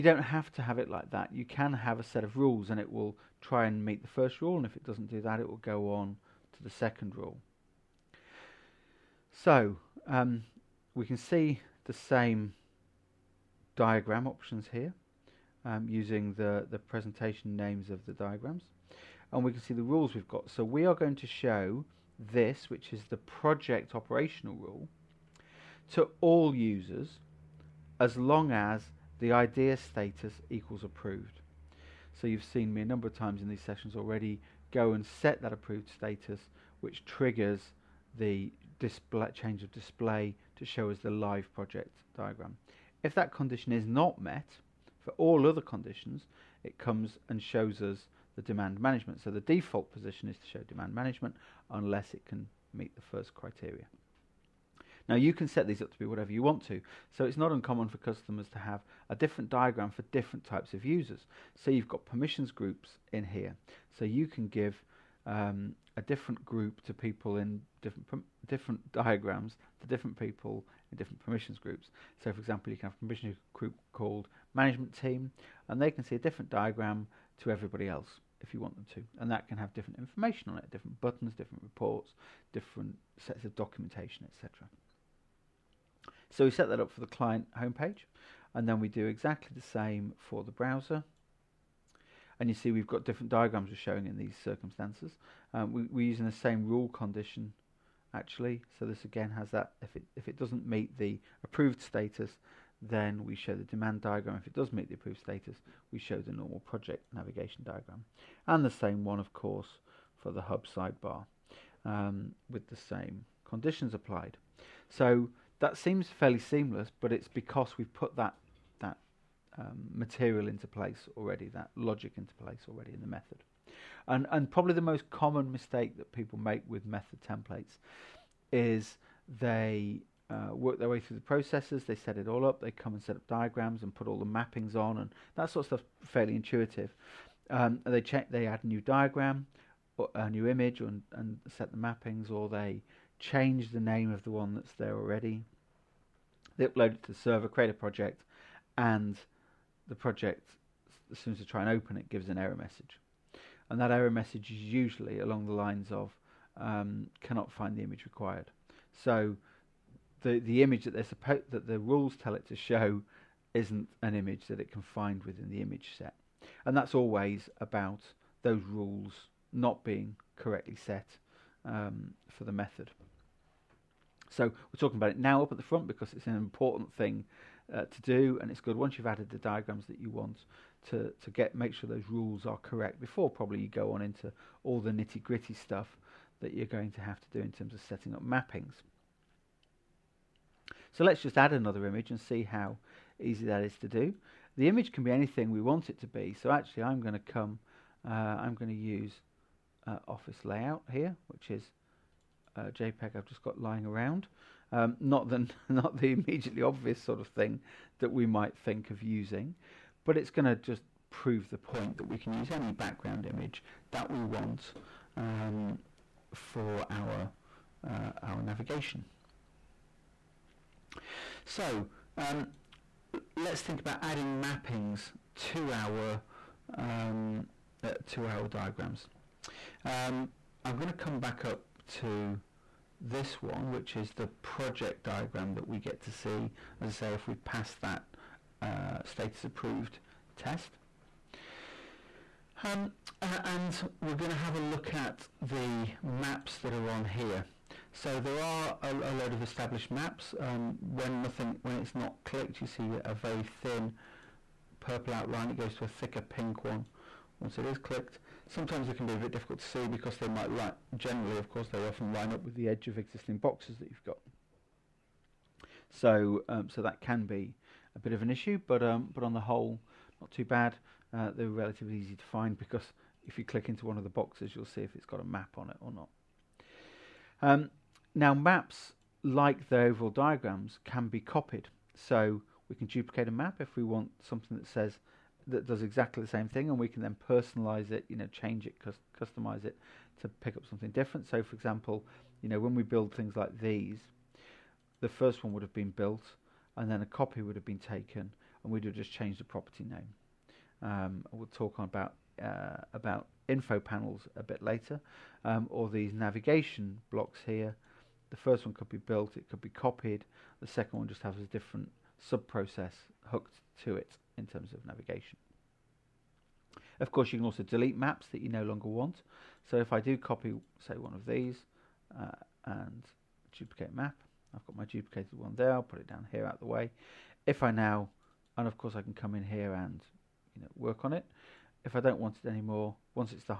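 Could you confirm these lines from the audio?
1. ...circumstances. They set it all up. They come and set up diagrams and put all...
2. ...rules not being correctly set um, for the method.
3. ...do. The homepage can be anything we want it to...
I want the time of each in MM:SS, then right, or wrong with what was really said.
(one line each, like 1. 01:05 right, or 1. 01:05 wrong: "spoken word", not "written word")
1. 02:11 wrong: "processes", not "circumstances"
2. 02:48 right
3. 03:13 wrong: "image", not "homepage".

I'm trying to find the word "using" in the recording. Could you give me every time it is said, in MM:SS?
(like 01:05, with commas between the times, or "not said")
00:15, 01:36, 03:29.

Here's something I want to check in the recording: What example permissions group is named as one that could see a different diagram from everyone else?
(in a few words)
Management team.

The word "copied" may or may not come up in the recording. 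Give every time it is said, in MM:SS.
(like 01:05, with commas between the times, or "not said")
04:41, 05:09.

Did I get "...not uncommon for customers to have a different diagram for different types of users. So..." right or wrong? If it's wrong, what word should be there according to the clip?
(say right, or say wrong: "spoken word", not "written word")
right.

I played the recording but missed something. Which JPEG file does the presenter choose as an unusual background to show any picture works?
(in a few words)
Office layout.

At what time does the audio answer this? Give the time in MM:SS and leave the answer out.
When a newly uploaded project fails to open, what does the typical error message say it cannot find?
02:37.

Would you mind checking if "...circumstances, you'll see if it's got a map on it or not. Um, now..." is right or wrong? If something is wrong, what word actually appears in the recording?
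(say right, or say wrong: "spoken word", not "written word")
wrong: "boxes", not "circumstances".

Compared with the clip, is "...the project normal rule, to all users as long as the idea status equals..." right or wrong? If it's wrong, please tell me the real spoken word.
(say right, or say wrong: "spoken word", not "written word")
wrong: "operational", not "normal".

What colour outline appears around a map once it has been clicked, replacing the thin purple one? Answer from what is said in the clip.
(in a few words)
Pink.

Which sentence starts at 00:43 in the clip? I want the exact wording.
If that condition is not met, for all other conditions, it comes and shows us the demand management.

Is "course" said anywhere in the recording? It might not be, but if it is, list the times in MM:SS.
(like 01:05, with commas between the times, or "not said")
01:49, 04:21, 05:17, 05:28.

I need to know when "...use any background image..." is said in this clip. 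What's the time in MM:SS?
03:32.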